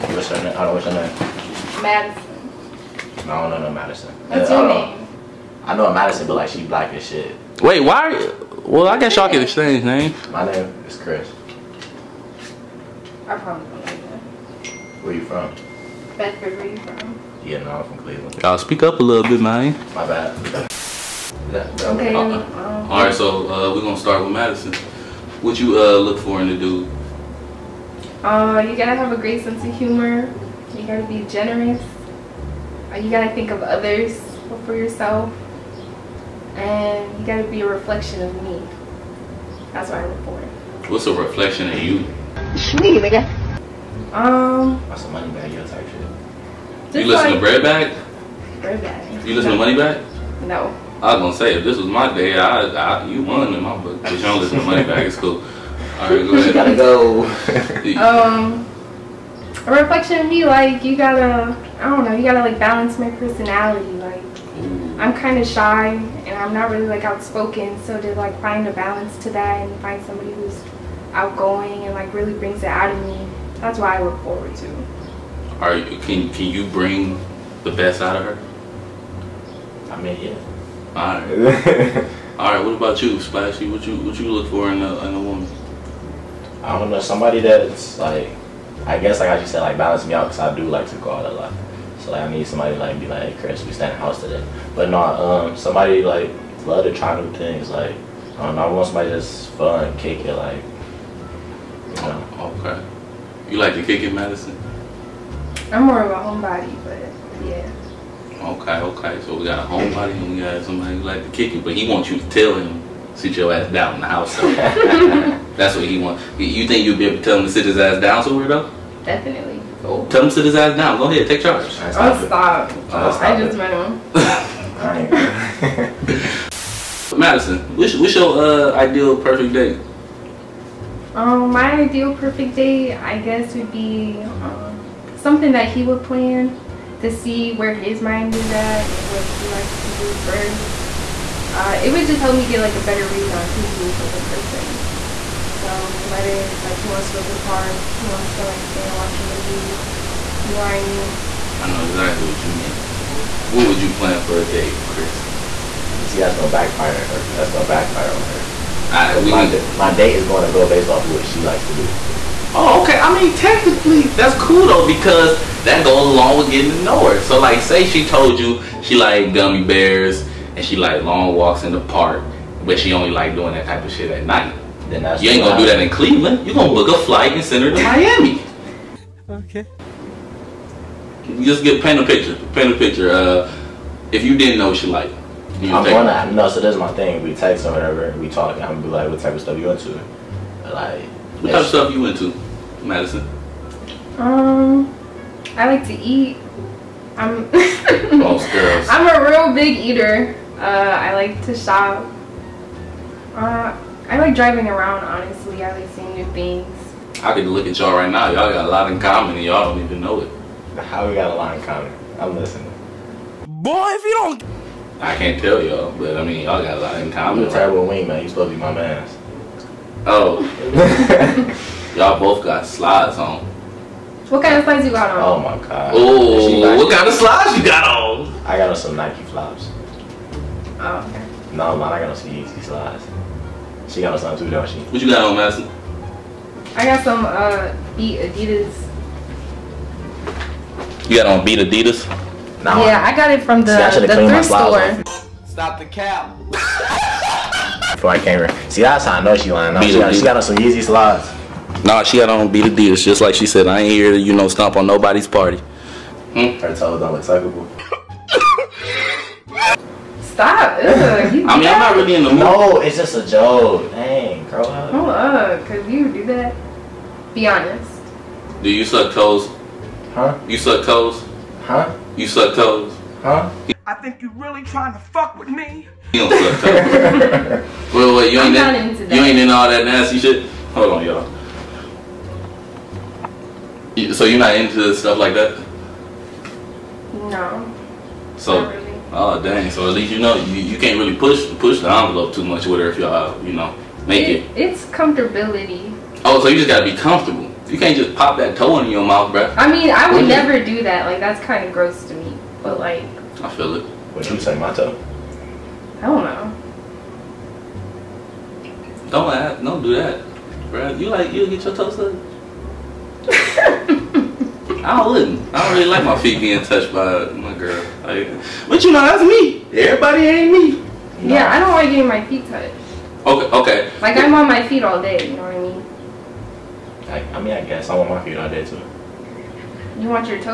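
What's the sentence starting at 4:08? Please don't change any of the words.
See, that's how I know she lying.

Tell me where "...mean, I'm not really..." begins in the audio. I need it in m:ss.
4:21.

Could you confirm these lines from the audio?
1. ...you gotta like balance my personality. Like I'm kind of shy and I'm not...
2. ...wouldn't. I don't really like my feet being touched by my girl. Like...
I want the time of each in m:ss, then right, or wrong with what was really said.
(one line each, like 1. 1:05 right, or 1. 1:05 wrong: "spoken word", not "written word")
1. 1:02 right
2. 5:15 right.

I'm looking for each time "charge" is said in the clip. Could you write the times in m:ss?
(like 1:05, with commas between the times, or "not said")
2:01.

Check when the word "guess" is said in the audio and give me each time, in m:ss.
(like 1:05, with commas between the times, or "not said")
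0:08, 1:28, 2:13, 5:27.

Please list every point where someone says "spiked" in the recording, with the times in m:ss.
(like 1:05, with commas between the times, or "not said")
not said.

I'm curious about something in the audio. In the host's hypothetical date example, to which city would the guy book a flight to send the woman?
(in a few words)
Miami.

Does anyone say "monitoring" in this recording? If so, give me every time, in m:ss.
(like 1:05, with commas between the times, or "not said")
not said.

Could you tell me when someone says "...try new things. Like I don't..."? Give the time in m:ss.
1:36.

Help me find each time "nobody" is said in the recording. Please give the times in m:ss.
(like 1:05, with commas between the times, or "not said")
4:14.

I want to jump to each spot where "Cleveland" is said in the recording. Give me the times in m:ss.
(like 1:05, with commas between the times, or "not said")
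0:17, 2:55.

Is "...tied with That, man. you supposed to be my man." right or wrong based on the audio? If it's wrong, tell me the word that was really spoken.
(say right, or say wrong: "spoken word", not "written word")
wrong: "Wing", not "That".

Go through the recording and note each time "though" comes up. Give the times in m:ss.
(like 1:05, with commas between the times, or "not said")
1:58, 2:44.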